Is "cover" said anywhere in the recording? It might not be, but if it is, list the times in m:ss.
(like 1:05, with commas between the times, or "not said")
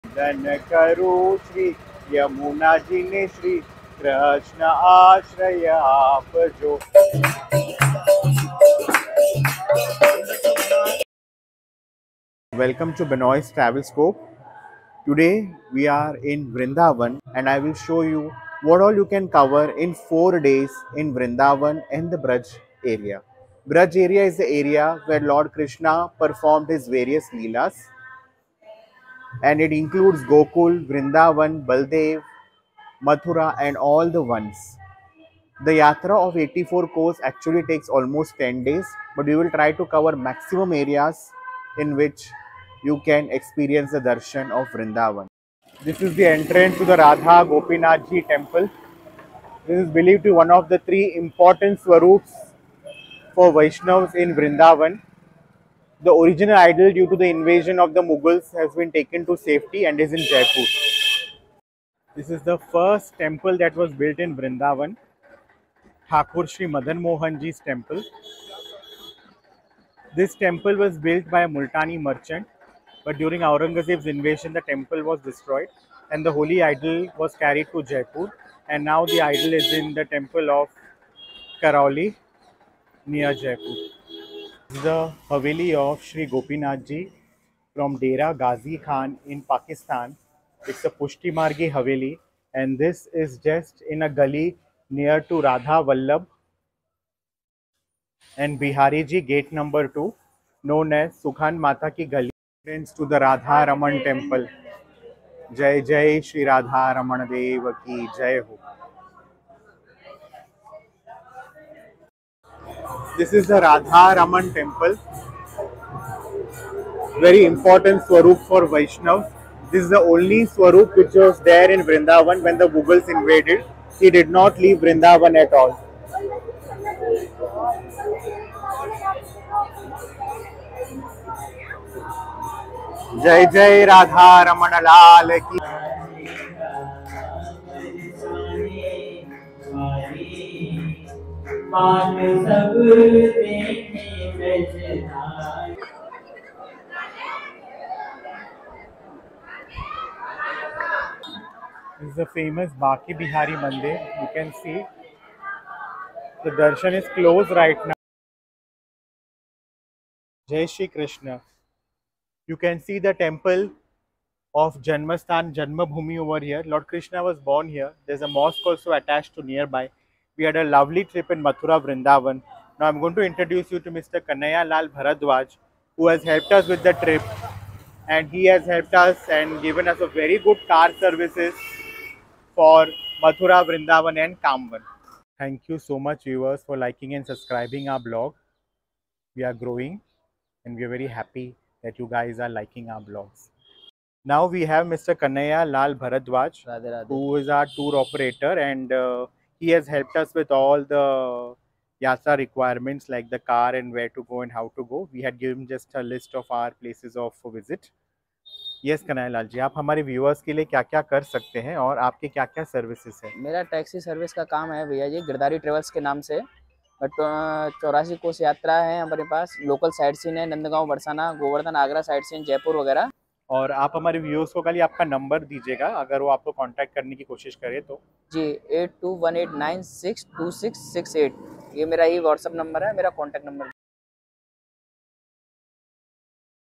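0:19, 0:39.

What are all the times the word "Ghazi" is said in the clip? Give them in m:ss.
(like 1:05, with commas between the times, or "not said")
1:28.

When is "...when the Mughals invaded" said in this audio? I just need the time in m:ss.
2:02.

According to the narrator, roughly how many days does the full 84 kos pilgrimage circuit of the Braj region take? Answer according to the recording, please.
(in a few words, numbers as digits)
10 days.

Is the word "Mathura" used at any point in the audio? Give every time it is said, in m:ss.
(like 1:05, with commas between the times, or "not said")
0:33, 2:51, 3:03.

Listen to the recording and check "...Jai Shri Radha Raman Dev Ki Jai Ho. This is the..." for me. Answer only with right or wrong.
right.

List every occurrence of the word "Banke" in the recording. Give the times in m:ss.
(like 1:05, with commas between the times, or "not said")
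2:32.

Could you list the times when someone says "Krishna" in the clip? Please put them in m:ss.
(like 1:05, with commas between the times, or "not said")
0:25, 2:40, 2:46.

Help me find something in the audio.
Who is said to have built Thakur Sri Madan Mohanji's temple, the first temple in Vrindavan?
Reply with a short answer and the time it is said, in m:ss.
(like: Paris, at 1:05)
A Multani merchant, at 1:11.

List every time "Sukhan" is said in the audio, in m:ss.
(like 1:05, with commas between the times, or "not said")
1:41.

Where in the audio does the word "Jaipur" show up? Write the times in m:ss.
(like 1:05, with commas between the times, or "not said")
1:00, 1:17, 1:23.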